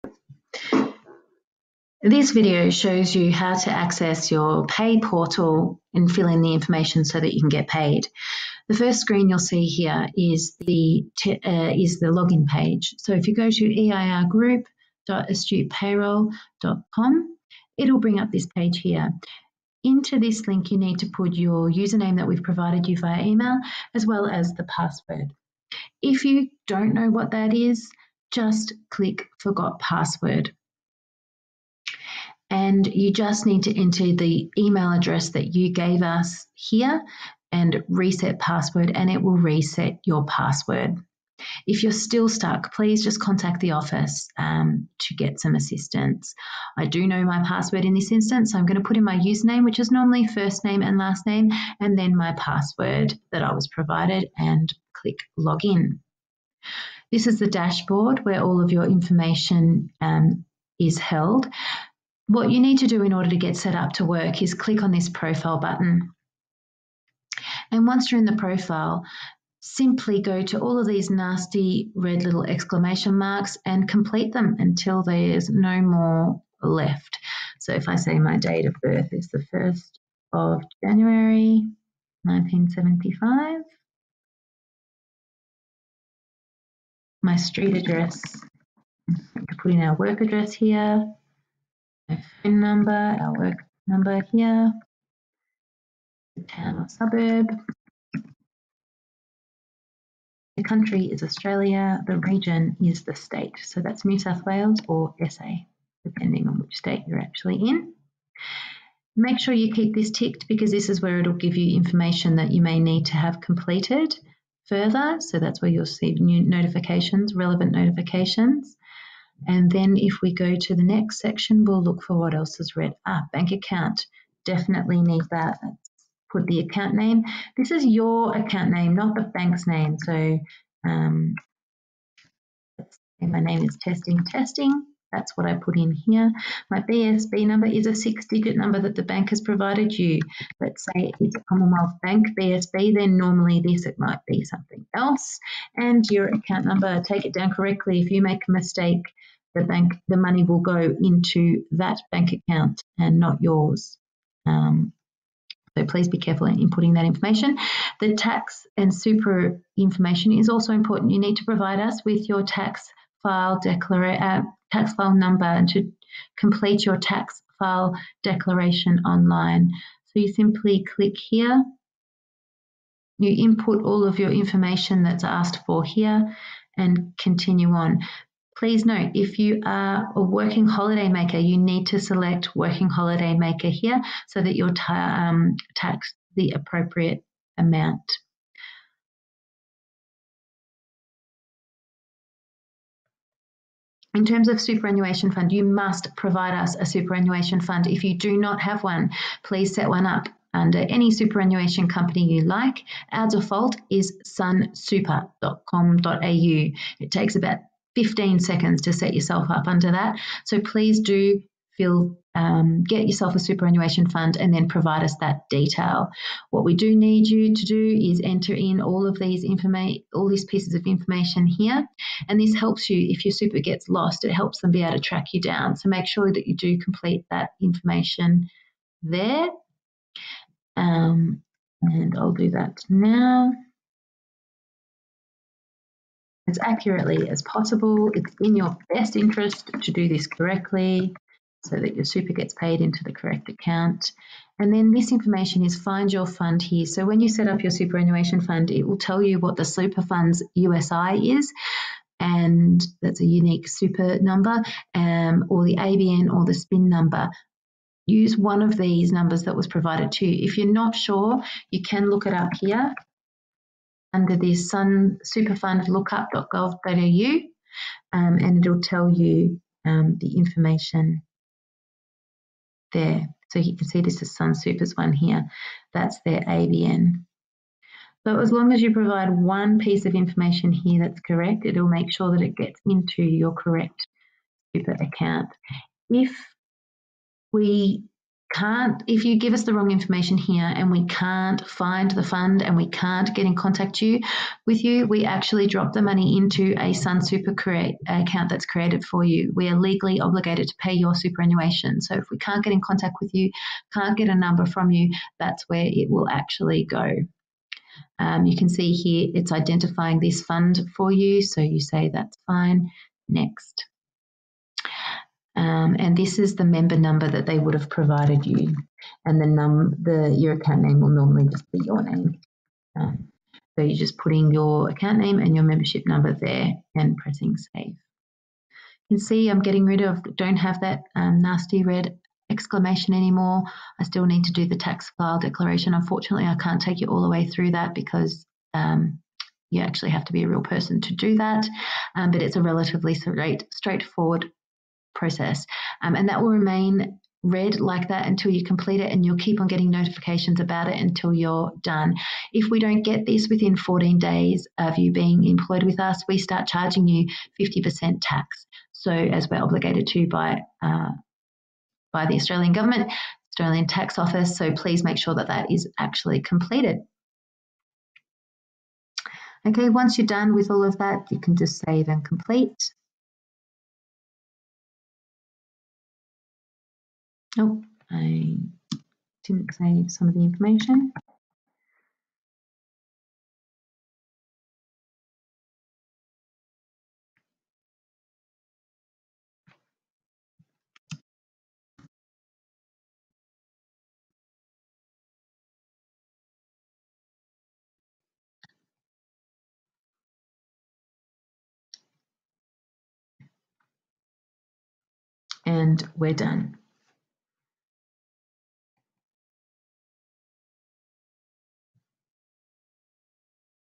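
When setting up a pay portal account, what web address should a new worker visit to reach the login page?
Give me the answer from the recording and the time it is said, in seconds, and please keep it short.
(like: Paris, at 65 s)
eirgroup.astutepayroll.com, at 13 s.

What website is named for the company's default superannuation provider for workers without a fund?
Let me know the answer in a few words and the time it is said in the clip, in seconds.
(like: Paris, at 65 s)
sunsuper.com.au, at 204 s.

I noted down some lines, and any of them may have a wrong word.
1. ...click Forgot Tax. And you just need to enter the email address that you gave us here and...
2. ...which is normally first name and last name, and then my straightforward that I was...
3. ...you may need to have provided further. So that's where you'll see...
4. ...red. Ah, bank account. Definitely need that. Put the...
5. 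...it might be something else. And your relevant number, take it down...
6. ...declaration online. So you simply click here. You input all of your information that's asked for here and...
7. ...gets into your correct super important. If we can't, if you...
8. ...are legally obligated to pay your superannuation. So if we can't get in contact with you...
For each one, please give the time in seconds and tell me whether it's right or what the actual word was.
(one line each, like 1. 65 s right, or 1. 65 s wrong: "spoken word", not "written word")
1. 28 s wrong: "Password", not "Tax"
2. 49 s wrong: "password", not "straightforward"
3. 112 s wrong: "completed", not "provided"
4. 122 s right
5. 143 s wrong: "account", not "relevant"
6. 168 s right
7. 282 s wrong: "account", not "important"
8. 299 s right.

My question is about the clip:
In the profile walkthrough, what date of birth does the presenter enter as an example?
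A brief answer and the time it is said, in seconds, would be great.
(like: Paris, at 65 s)
1st of January 1975, at 79 s.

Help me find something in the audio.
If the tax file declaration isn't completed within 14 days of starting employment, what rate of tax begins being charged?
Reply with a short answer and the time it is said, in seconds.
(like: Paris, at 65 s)
50%, at 357 s.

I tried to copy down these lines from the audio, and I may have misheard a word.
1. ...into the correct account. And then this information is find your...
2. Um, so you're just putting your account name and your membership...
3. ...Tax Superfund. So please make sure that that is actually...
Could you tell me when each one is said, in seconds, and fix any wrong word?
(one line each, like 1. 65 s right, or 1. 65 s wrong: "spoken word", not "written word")
1. 242 s right
2. 322 s right
3. 363 s wrong: "Office", not "Superfund".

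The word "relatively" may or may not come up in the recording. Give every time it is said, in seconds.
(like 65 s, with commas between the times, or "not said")
342 s.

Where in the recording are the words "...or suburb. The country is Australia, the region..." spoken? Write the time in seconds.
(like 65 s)
96 s.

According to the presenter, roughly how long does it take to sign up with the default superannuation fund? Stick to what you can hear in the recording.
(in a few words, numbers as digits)
15 seconds.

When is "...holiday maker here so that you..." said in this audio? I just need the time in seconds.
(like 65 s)
182 s.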